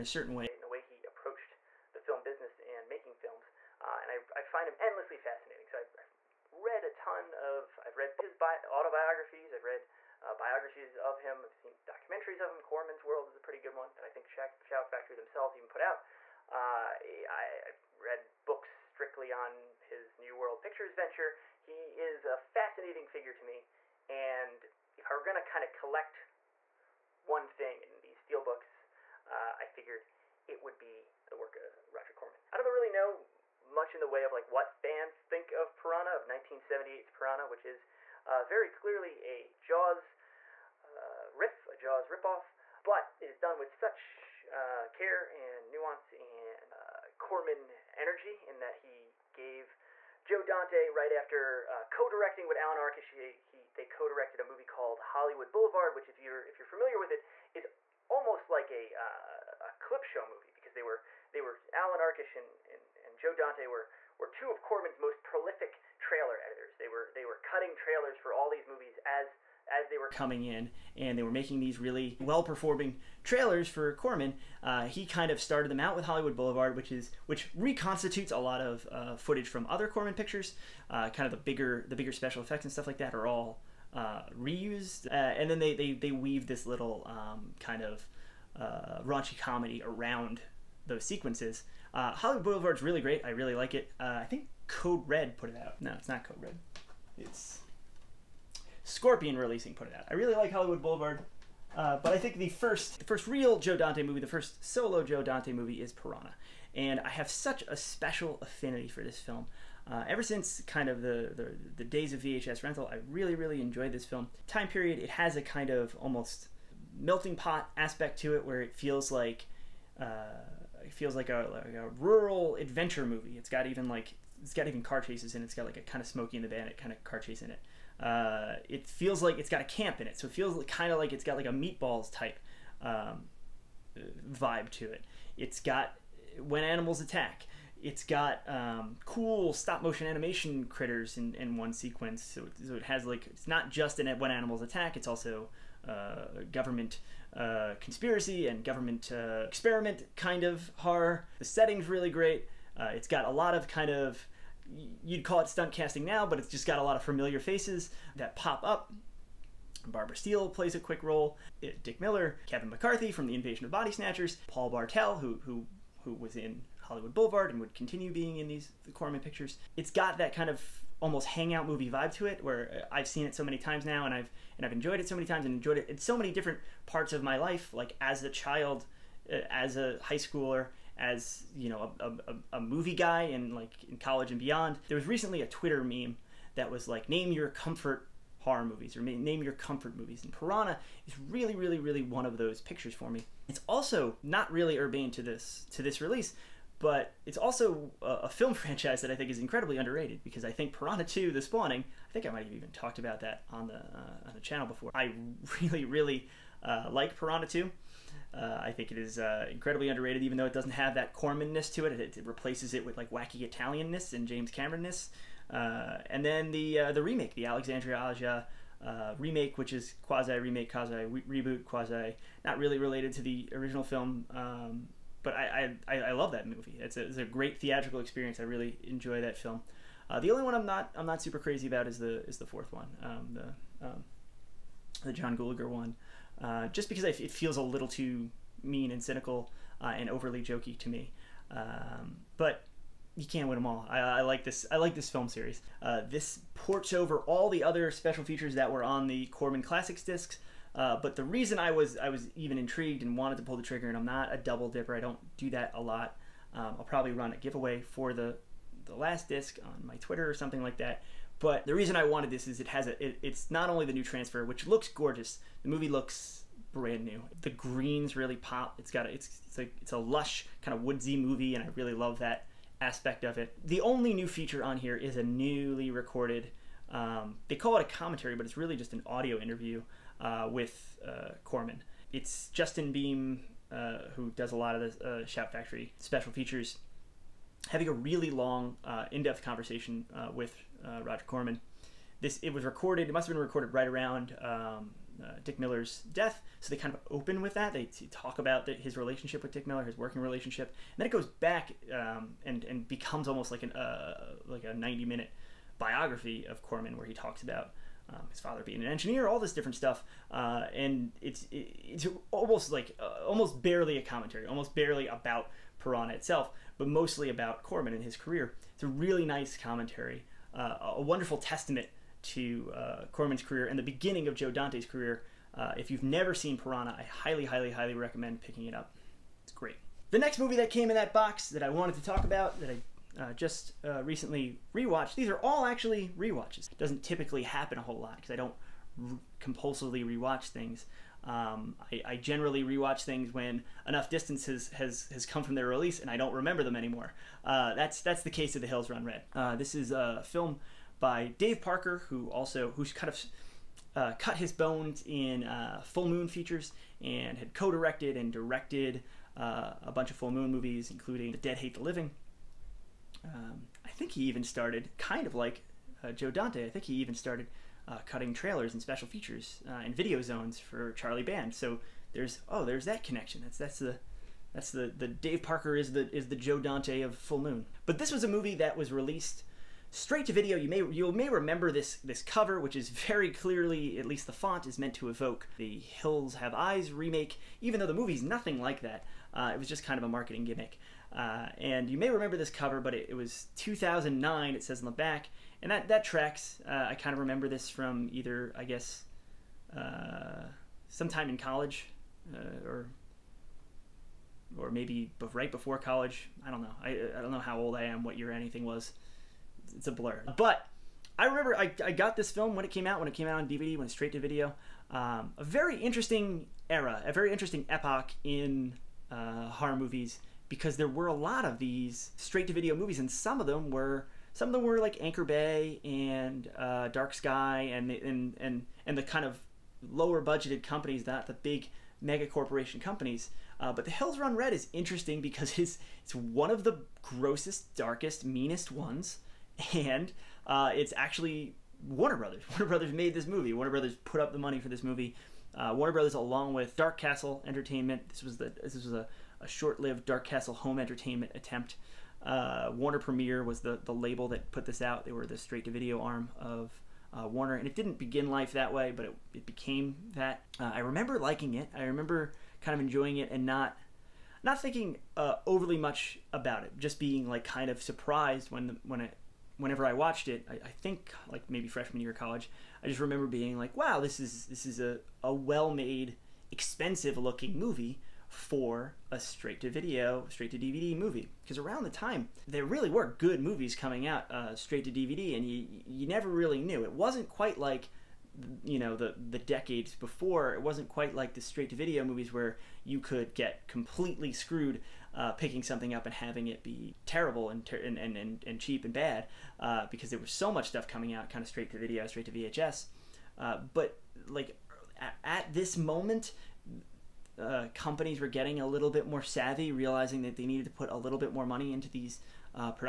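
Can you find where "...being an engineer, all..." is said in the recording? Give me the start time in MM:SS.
05:08.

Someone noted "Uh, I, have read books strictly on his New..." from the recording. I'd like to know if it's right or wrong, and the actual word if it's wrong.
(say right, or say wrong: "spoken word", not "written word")
right.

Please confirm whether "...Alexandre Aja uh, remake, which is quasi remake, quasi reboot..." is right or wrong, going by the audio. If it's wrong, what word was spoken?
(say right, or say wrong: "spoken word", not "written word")
right.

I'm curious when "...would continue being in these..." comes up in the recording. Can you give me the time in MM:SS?
02:47.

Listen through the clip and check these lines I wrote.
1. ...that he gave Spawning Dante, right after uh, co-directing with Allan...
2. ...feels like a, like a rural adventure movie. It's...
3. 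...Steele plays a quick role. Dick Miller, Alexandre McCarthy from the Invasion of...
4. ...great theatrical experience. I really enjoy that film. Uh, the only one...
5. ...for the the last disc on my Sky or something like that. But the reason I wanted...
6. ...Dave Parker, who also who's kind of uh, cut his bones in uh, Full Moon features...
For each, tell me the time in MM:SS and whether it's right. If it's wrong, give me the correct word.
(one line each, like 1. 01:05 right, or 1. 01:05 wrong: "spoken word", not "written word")
1. 00:48 wrong: "Joe", not "Spawning"
2. 02:00 right
3. 02:40 wrong: "Kevin", not "Alexandre"
4. 03:47 right
5. 04:17 wrong: "Twitter", not "Sky"
6. 05:51 right.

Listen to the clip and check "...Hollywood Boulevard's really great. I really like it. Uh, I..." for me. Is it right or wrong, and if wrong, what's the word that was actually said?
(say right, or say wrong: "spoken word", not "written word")
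right.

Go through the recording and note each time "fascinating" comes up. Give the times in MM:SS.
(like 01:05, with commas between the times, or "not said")
00:05, 00:22.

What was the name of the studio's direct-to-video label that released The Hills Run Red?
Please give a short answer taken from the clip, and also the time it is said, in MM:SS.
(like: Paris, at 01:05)
Warner Premiere, at 07:32.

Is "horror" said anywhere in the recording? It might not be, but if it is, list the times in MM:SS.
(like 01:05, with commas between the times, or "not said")
02:30, 03:08, 06:59.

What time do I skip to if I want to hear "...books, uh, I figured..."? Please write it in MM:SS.
00:28.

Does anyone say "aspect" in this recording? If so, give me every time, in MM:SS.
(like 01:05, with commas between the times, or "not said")
01:57, 04:32.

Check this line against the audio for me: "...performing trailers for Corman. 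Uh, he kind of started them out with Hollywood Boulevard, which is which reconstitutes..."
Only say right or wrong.
right.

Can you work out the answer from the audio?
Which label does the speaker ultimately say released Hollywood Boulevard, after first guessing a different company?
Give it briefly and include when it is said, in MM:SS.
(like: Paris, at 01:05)
Scorpion Releasing, at 01:38.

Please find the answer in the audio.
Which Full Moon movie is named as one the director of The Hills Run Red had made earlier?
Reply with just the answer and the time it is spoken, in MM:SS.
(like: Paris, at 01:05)
The Dead Hate the Living, at 06:01.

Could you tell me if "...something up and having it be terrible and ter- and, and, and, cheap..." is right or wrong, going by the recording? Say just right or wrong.
right.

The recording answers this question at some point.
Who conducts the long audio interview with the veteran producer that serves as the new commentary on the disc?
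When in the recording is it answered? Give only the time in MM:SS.
04:42.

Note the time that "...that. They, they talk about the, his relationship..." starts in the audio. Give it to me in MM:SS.
04:57.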